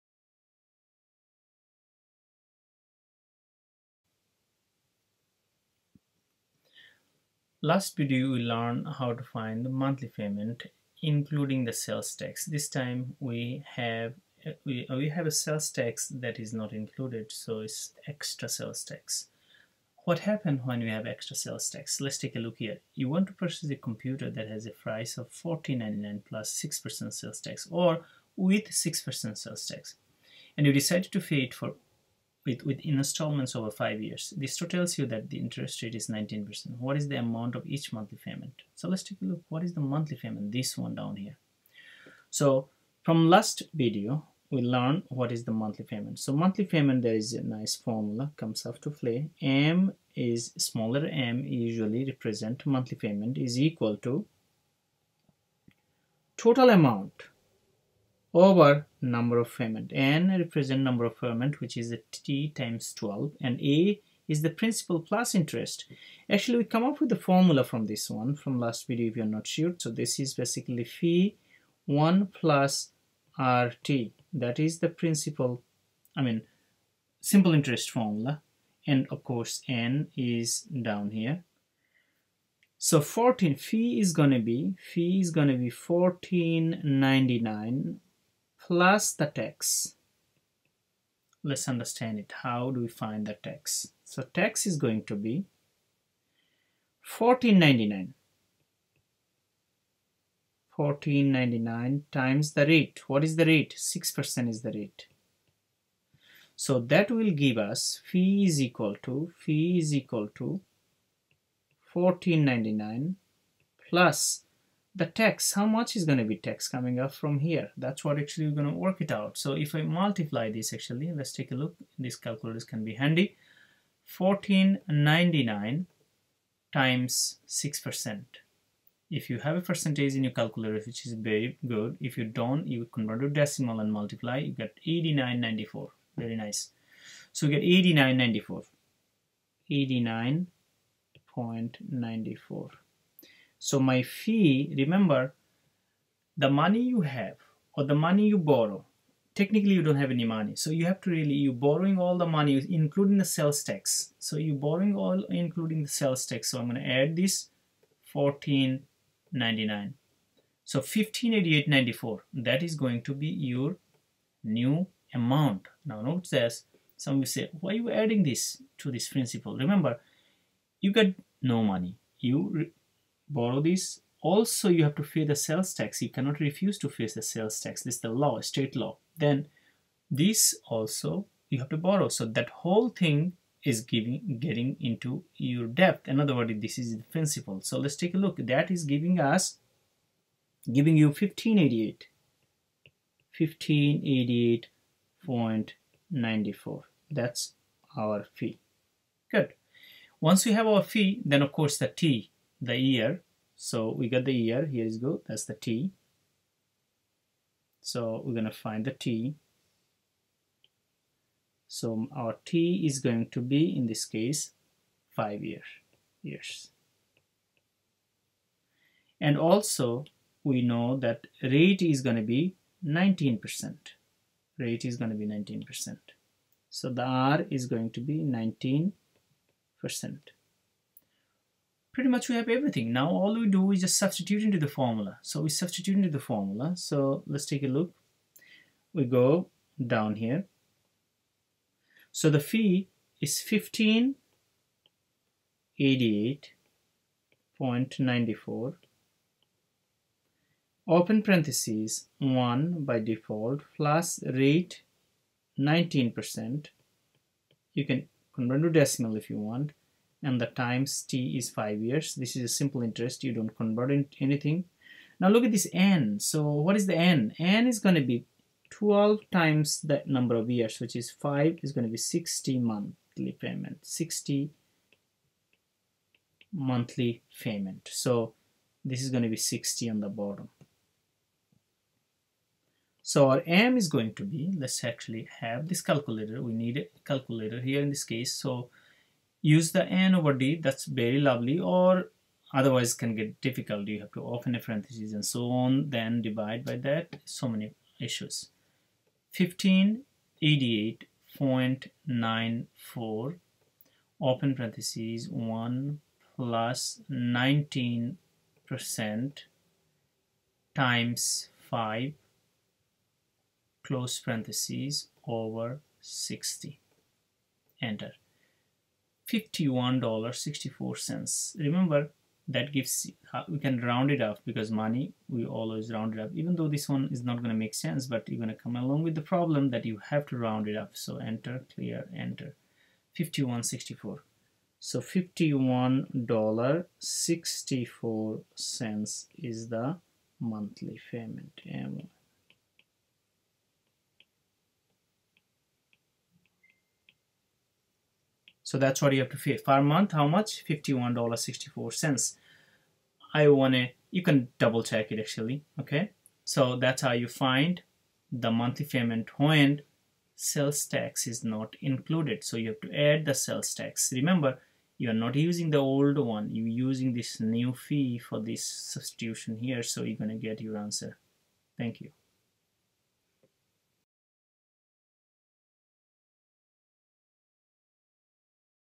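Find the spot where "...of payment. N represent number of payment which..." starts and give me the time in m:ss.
0:59.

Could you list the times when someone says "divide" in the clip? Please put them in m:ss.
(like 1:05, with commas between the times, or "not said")
4:56.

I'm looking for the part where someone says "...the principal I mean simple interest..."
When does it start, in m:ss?
1:14.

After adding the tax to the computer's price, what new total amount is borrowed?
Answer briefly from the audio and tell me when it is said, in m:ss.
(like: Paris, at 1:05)
1588.94, at 2:40.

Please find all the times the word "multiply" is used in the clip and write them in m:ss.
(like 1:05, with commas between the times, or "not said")
1:59, 2:13.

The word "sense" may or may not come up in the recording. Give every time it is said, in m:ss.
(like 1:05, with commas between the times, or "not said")
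5:27.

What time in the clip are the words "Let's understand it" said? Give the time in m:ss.
1:31.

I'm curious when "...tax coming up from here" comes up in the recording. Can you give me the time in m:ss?
1:56.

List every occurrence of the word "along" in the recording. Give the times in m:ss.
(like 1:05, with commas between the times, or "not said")
5:28.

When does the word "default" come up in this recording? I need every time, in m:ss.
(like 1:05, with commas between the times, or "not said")
4:12.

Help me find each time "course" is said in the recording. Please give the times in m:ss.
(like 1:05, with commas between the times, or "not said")
1:19, 3:21.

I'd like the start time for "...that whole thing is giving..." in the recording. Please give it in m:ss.
3:02.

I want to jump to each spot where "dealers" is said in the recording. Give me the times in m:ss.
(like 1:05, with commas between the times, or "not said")
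not said.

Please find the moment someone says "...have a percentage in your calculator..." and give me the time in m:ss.
2:09.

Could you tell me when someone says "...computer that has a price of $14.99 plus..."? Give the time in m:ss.
0:23.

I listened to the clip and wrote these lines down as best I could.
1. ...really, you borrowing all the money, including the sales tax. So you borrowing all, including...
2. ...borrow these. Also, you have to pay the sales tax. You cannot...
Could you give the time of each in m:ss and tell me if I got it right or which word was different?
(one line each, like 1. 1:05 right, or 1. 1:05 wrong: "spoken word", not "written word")
1. 2:31 right
2. 2:53 right.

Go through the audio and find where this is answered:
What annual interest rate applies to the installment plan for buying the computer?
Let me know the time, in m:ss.
0:35.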